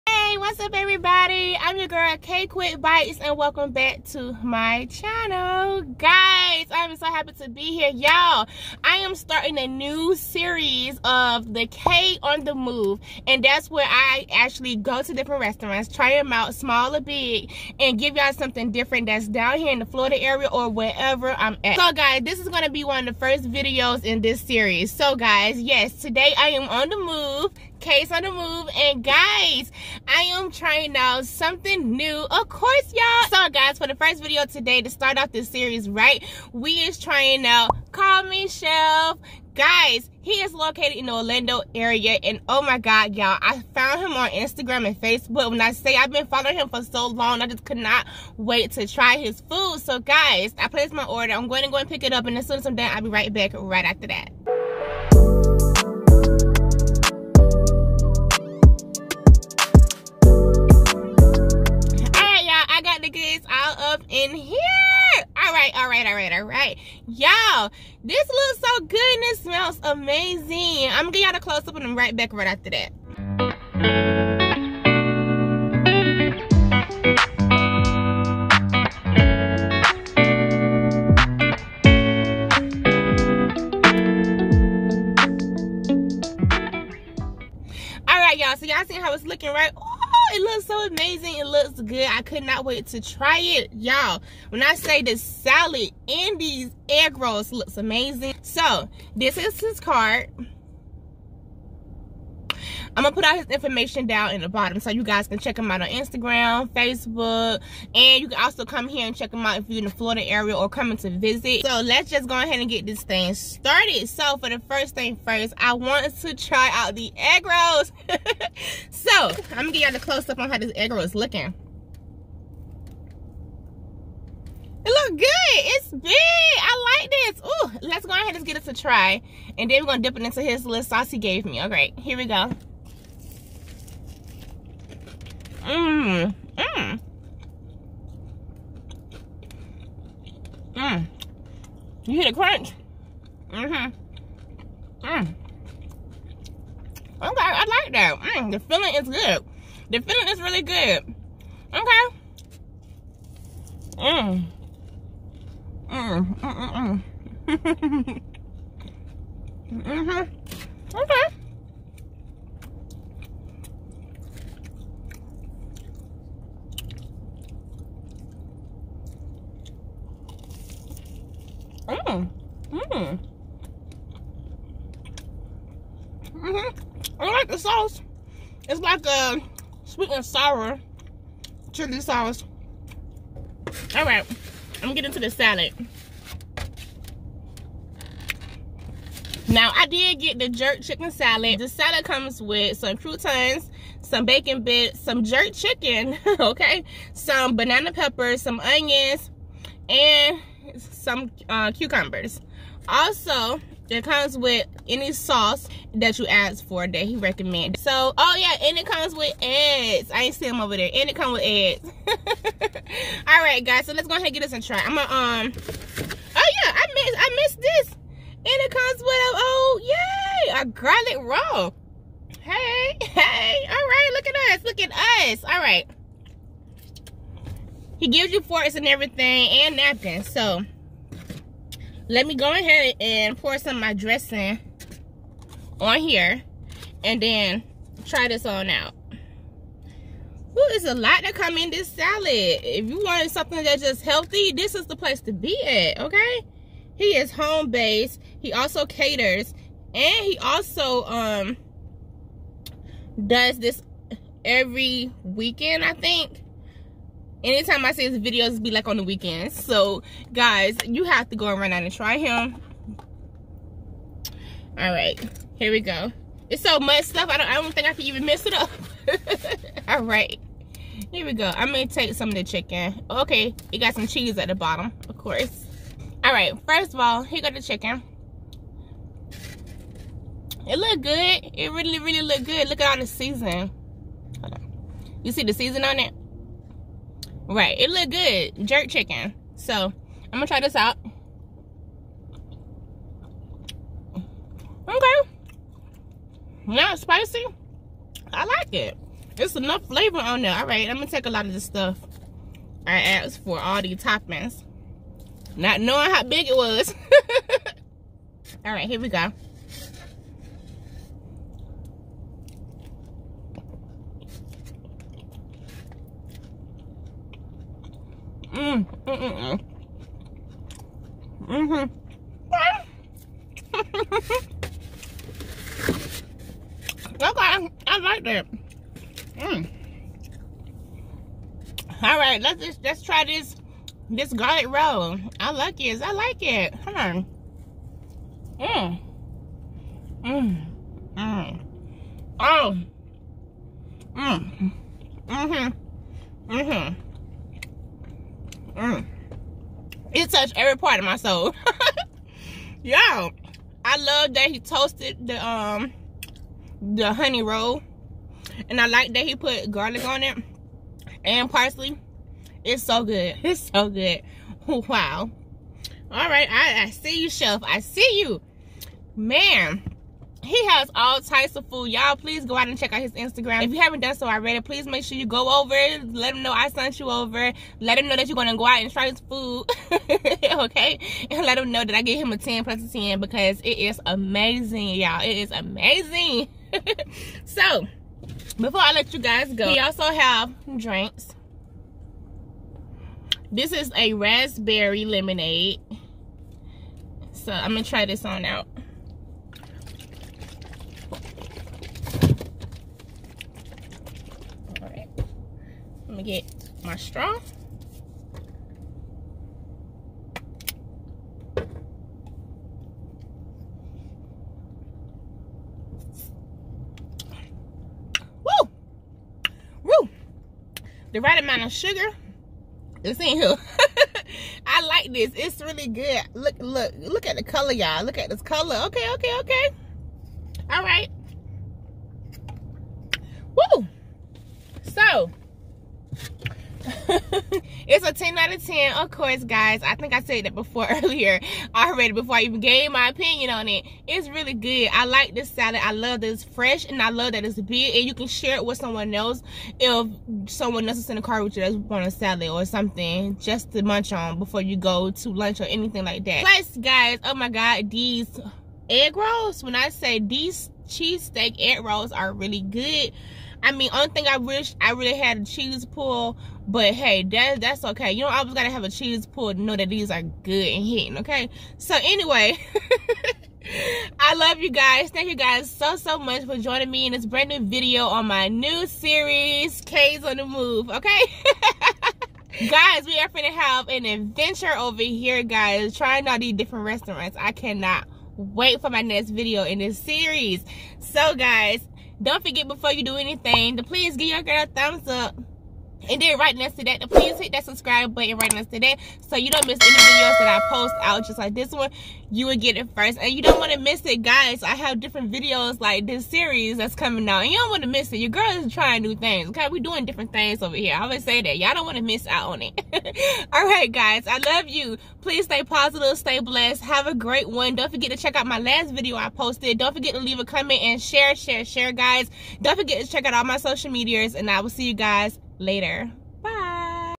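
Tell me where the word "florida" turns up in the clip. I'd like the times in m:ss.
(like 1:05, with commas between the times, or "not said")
0:19, 1:49.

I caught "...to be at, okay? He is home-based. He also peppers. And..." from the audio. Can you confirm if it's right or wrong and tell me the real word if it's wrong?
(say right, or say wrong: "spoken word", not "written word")
wrong: "caters", not "peppers".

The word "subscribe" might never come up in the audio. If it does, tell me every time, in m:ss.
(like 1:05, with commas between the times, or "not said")
8:17.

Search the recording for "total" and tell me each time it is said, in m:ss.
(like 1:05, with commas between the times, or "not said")
not said.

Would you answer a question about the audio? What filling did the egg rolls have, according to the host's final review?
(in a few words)
Cheesesteak.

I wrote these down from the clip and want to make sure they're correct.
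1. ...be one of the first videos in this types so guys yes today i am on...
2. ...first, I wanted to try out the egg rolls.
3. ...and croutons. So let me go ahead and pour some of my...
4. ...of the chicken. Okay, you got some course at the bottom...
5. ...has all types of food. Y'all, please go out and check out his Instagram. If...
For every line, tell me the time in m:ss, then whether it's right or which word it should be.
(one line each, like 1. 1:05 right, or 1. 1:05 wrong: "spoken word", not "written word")
1. 0:22 wrong: "series", not "types"
2. 1:55 right
3. 3:49 wrong: "napkins", not "croutons"
4. 4:32 wrong: "cheese", not "course"
5. 6:10 right.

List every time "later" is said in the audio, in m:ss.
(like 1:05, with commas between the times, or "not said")
8:45.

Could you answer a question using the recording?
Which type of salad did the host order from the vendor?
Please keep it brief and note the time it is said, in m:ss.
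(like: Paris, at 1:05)
Jerk chicken salad, at 3:10.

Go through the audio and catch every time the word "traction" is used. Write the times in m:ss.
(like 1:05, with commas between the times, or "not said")
not said.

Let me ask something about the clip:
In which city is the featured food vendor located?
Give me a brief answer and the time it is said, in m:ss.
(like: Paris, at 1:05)
Orlando, at 0:41.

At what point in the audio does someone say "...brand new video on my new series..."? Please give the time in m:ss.
7:57.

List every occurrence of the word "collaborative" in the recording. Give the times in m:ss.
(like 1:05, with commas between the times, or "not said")
not said.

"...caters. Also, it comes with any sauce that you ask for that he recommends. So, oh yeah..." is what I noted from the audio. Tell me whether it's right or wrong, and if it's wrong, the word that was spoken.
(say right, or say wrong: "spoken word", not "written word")
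wrong: "cucumbers", not "caters".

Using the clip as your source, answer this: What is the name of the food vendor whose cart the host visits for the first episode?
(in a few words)
Call Me Chef.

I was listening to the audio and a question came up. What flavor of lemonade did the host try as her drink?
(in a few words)
Raspberry.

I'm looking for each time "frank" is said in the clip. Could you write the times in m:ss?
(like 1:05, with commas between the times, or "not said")
not said.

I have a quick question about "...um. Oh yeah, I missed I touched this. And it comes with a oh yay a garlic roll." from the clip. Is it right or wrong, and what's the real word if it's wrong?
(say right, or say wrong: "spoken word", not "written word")
wrong: "missed", not "touched".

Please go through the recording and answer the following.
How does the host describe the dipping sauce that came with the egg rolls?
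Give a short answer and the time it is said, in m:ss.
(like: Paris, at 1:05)
Sweet and sour chili sauce, at 2:59.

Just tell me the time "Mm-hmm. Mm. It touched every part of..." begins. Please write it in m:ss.
5:46.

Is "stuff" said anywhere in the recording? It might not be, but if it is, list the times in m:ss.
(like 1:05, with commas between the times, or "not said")
4:27, 5:01.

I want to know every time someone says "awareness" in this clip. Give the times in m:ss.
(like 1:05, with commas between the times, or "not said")
not said.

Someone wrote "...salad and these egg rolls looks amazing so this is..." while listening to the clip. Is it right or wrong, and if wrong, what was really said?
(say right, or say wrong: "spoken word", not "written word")
right.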